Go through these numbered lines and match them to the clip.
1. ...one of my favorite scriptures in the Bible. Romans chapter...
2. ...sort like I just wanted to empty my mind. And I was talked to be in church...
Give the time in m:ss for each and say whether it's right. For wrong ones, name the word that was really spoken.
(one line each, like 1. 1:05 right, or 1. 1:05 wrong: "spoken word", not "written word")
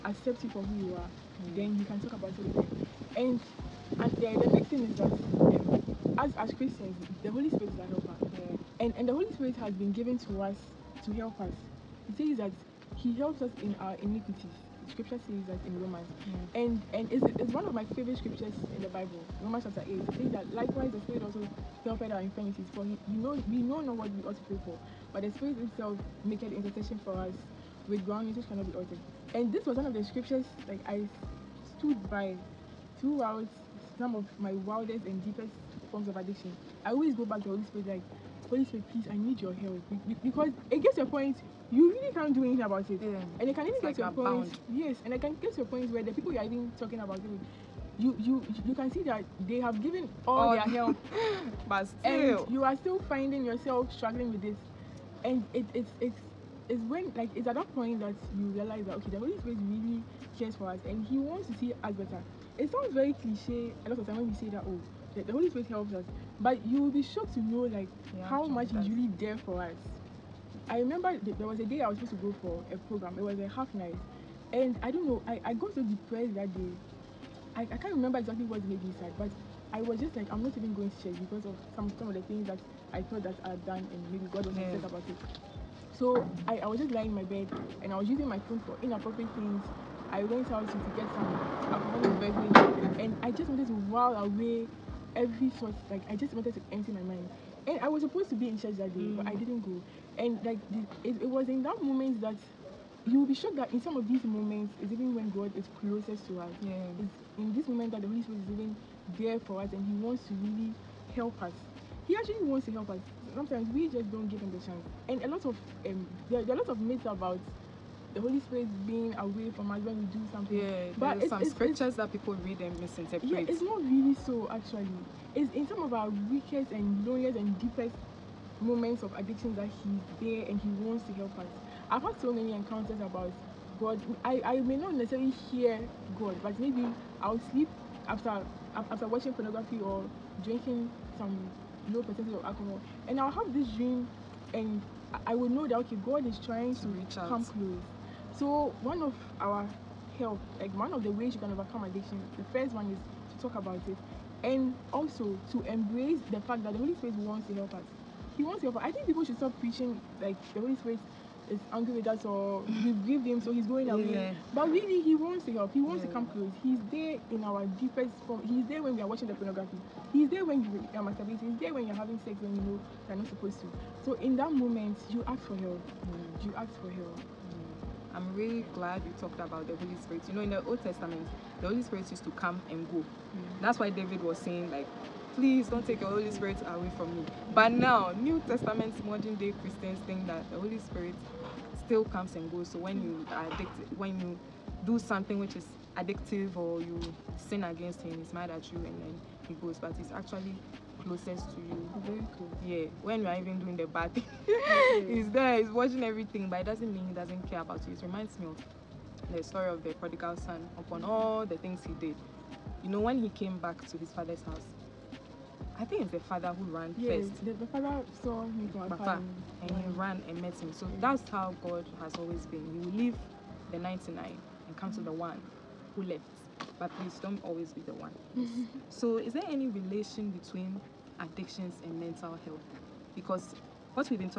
1. 0:17 right
2. 1:35 wrong: "supposed", not "talked".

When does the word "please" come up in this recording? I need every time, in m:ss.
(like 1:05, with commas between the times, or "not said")
0:38, 3:05, 3:46.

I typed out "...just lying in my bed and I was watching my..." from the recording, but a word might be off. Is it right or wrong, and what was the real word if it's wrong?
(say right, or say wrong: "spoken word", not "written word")
wrong: "using", not "watching".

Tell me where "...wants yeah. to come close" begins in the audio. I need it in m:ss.
2:45.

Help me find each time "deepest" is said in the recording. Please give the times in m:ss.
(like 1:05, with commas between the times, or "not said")
0:35, 2:07, 2:47.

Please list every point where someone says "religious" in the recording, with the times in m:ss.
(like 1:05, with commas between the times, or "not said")
not said.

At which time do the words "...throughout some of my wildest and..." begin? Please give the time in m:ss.
0:32.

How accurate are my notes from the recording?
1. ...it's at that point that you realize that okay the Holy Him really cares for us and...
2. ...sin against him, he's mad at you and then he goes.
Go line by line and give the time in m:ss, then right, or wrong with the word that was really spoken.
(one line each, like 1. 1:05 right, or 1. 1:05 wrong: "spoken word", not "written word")
1. 0:57 wrong: "Spirit", not "Him"
2. 3:17 right.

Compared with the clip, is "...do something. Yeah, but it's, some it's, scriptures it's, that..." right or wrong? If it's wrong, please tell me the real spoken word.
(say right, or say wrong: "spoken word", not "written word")
right.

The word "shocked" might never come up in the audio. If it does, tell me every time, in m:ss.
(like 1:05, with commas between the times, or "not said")
1:07, 1:43.